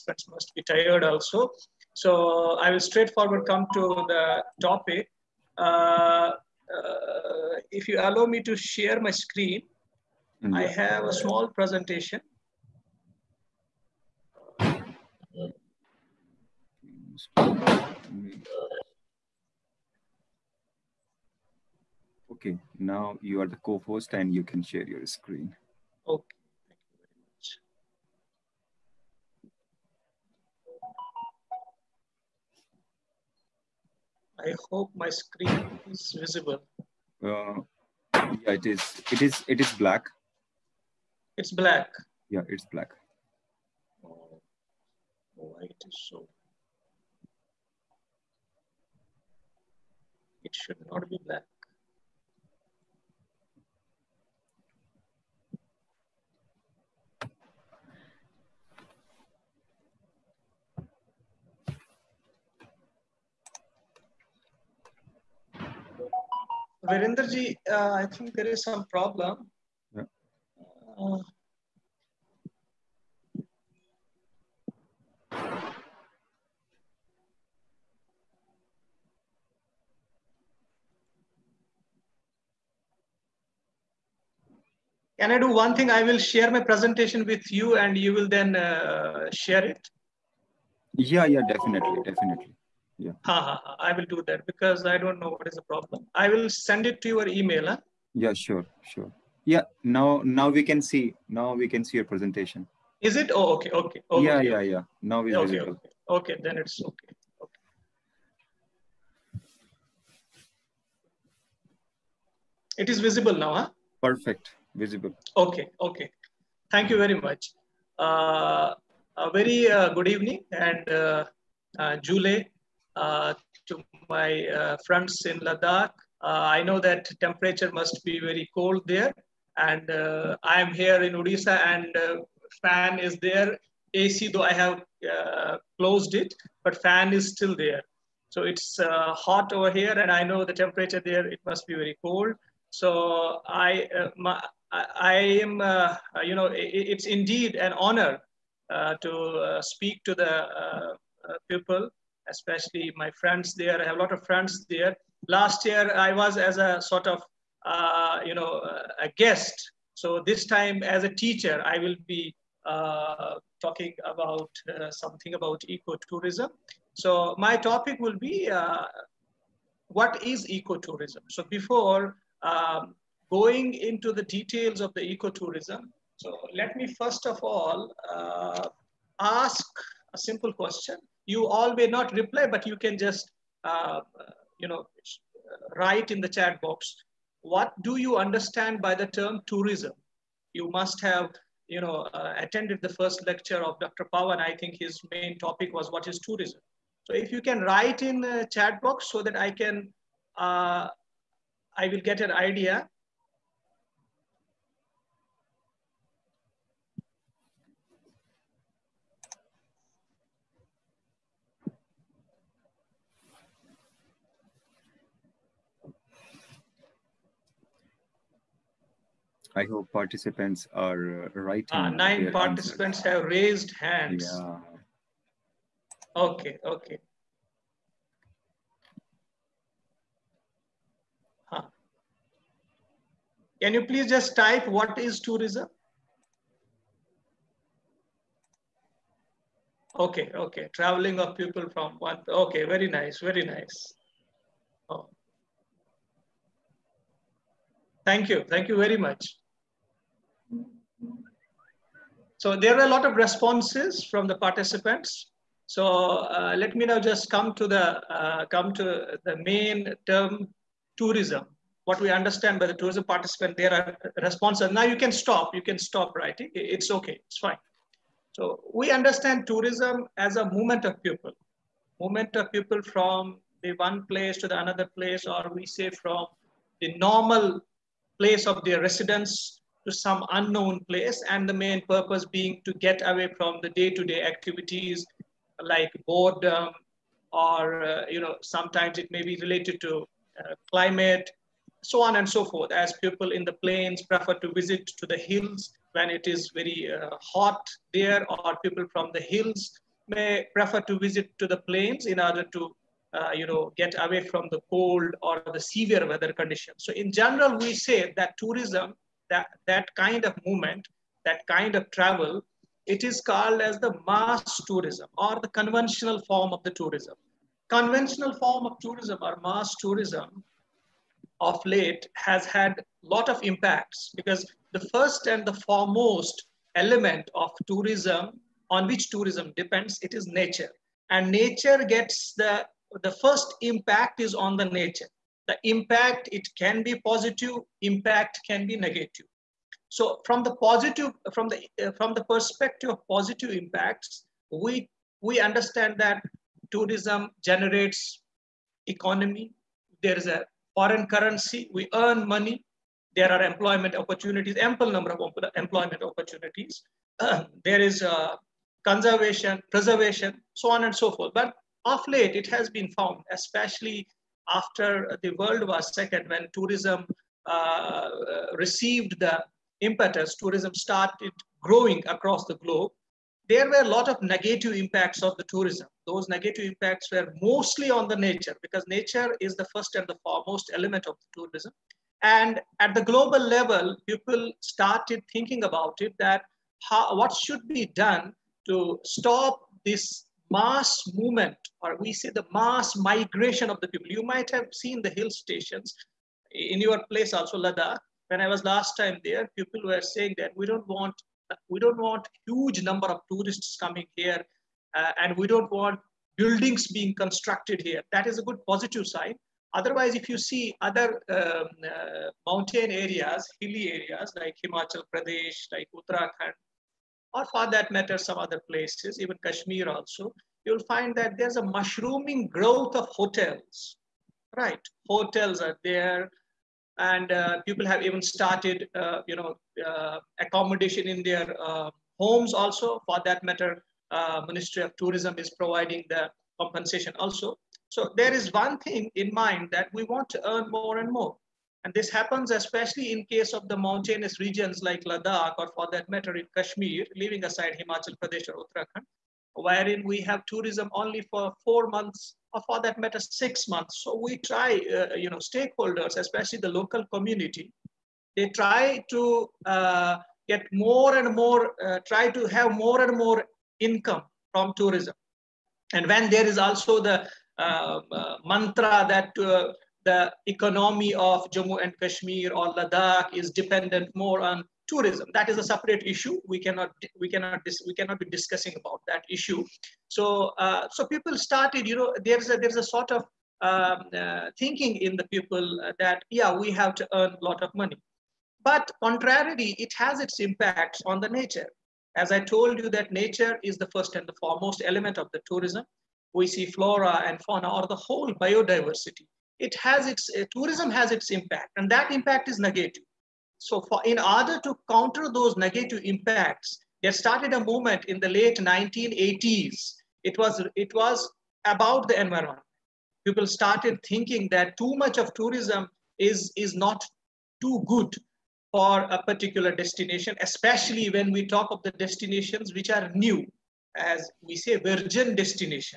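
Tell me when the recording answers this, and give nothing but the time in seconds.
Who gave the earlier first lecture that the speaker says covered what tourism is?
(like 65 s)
193 s.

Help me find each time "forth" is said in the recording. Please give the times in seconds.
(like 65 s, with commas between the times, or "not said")
292 s, 361 s.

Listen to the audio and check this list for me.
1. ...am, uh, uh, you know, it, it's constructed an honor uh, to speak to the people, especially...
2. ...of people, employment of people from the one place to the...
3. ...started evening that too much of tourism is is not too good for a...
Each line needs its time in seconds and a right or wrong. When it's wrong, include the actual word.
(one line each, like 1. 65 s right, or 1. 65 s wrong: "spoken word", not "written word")
1. 145 s wrong: "indeed", not "constructed"
2. 270 s wrong: "movement", not "employment"
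3. 513 s wrong: "thinking", not "evening".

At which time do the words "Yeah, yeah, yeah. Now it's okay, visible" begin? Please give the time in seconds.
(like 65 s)
104 s.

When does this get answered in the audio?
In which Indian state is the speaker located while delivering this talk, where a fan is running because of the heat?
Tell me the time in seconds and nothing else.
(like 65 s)
131 s.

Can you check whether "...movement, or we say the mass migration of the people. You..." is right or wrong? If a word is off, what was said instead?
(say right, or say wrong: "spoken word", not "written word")
right.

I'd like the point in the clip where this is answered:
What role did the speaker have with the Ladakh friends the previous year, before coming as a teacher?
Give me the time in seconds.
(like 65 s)
159 s.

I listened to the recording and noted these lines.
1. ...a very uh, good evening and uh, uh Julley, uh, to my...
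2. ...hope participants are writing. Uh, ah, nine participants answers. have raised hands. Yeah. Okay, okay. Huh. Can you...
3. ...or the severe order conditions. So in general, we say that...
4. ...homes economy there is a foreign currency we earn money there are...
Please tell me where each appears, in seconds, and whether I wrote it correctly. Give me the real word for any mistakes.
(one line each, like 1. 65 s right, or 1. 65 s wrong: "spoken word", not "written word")
1. 119 s right
2. 219 s right
3. 305 s wrong: "weather", not "order"
4. 347 s wrong: "generates", not "homes".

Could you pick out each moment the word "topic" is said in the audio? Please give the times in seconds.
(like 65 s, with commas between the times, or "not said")
4 s, 167 s, 195 s.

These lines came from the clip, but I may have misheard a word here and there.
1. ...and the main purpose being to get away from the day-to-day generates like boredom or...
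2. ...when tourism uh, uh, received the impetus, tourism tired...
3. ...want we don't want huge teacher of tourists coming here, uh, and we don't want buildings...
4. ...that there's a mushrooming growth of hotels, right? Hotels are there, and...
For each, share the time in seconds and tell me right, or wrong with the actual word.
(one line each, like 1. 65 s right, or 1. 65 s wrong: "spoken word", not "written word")
1. 281 s wrong: "activities", not "generates"
2. 366 s wrong: "started", not "tired"
3. 400 s wrong: "number", not "teacher"
4. 421 s right.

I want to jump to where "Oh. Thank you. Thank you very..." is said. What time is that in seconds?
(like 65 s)
244 s.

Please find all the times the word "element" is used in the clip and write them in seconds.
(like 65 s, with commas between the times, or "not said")
326 s, 380 s, 494 s.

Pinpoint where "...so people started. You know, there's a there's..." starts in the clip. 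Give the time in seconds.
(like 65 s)
480 s.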